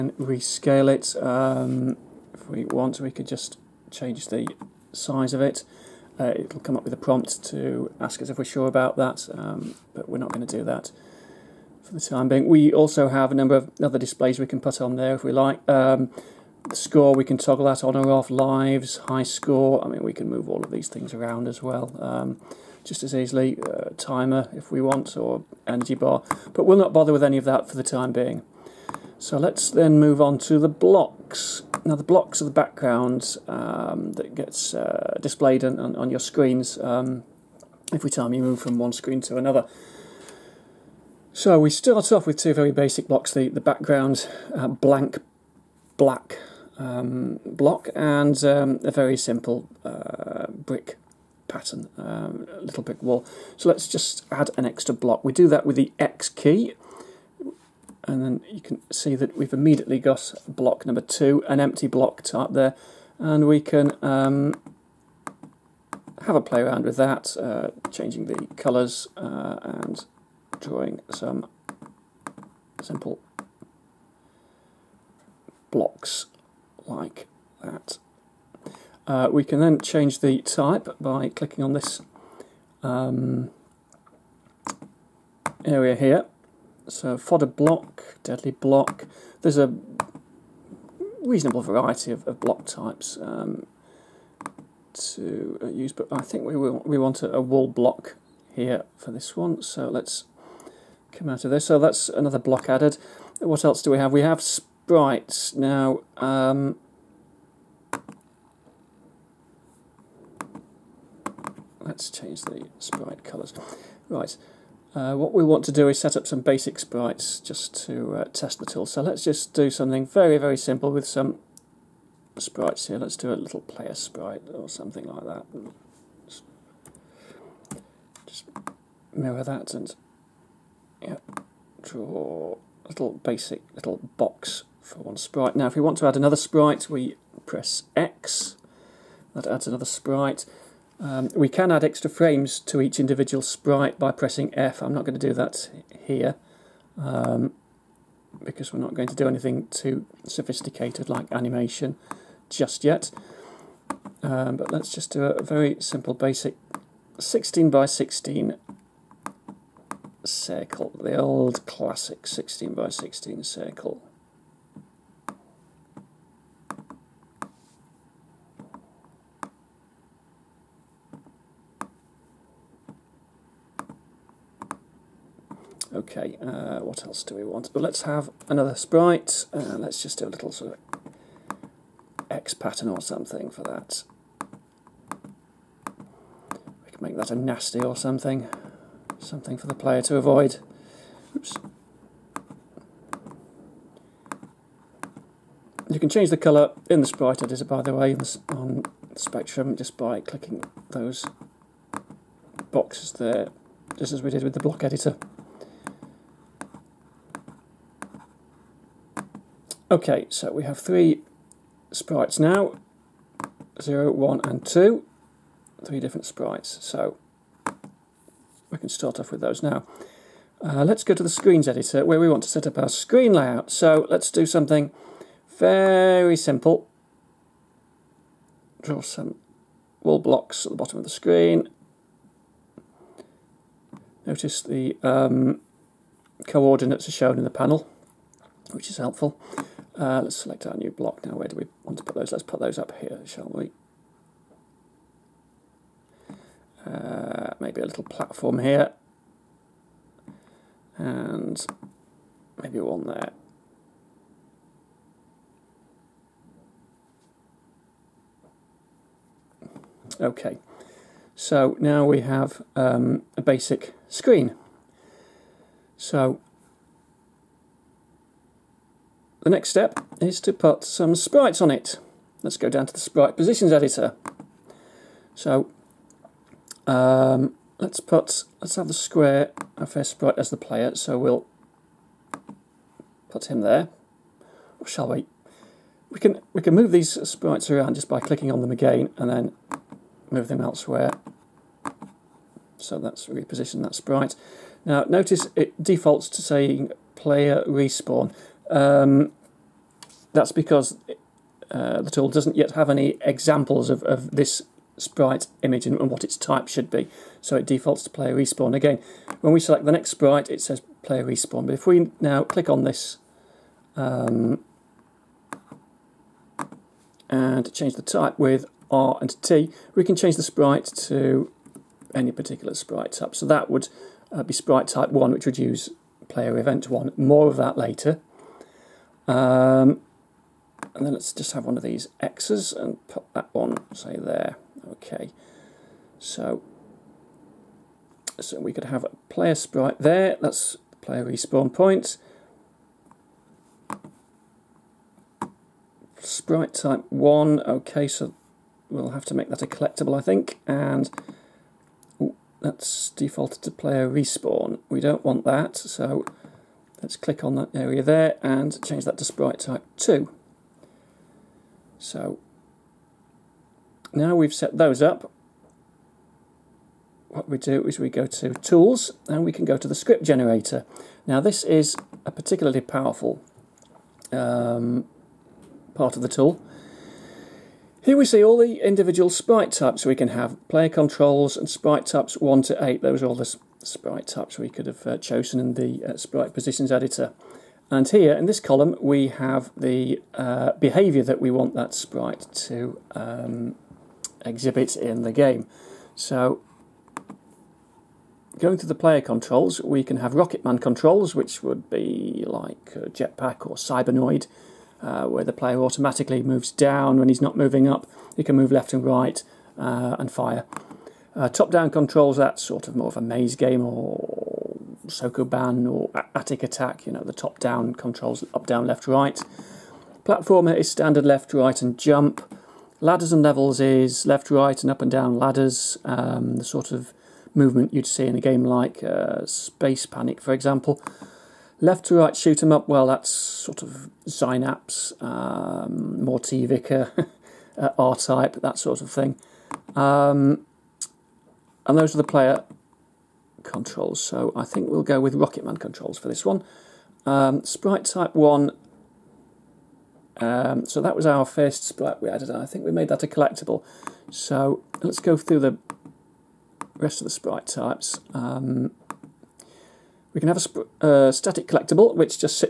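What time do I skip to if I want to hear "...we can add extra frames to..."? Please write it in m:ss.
2:21.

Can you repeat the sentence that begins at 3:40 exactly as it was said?
Uh, let's go to the screens editor where we want to set up our screen layout.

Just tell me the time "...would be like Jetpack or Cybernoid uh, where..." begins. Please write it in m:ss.
6:41.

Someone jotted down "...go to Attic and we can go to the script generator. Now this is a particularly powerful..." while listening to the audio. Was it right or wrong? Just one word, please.
wrong.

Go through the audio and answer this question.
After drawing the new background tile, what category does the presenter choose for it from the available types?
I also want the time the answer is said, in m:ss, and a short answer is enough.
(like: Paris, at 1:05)
Wall block, at 1:37.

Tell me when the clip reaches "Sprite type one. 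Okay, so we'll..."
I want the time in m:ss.
5:46.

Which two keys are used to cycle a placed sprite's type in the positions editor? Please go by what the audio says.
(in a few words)
R and T.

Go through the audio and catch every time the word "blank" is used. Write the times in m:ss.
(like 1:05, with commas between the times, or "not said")
0:44.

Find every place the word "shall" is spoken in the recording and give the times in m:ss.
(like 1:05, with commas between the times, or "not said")
4:03, 4:44.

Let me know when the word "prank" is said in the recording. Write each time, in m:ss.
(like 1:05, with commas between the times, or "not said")
not said.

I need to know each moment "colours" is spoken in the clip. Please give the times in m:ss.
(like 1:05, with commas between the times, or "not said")
1:08, 1:53, 3:16.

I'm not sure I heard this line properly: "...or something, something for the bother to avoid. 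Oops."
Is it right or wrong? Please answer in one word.
wrong.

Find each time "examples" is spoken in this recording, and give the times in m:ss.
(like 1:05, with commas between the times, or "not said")
5:03, 7:10.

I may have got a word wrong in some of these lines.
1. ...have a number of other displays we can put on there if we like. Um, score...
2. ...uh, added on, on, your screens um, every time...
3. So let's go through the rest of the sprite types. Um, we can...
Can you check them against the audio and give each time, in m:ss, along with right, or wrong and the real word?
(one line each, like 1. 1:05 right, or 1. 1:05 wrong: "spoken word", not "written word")
1. 0:13 right
2. 0:34 wrong: "displayed", not "added"
3. 7:34 right.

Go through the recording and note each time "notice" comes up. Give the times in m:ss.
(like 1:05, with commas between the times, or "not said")
3:54, 4:55.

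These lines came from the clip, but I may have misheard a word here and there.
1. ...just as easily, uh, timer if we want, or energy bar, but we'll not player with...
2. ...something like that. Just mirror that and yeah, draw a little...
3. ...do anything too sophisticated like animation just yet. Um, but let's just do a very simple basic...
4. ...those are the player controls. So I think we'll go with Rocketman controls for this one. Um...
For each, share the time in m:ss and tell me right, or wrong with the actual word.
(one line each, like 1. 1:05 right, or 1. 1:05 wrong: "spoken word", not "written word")
1. 0:22 wrong: "bother", not "player"
2. 2:04 right
3. 2:29 right
4. 7:21 right.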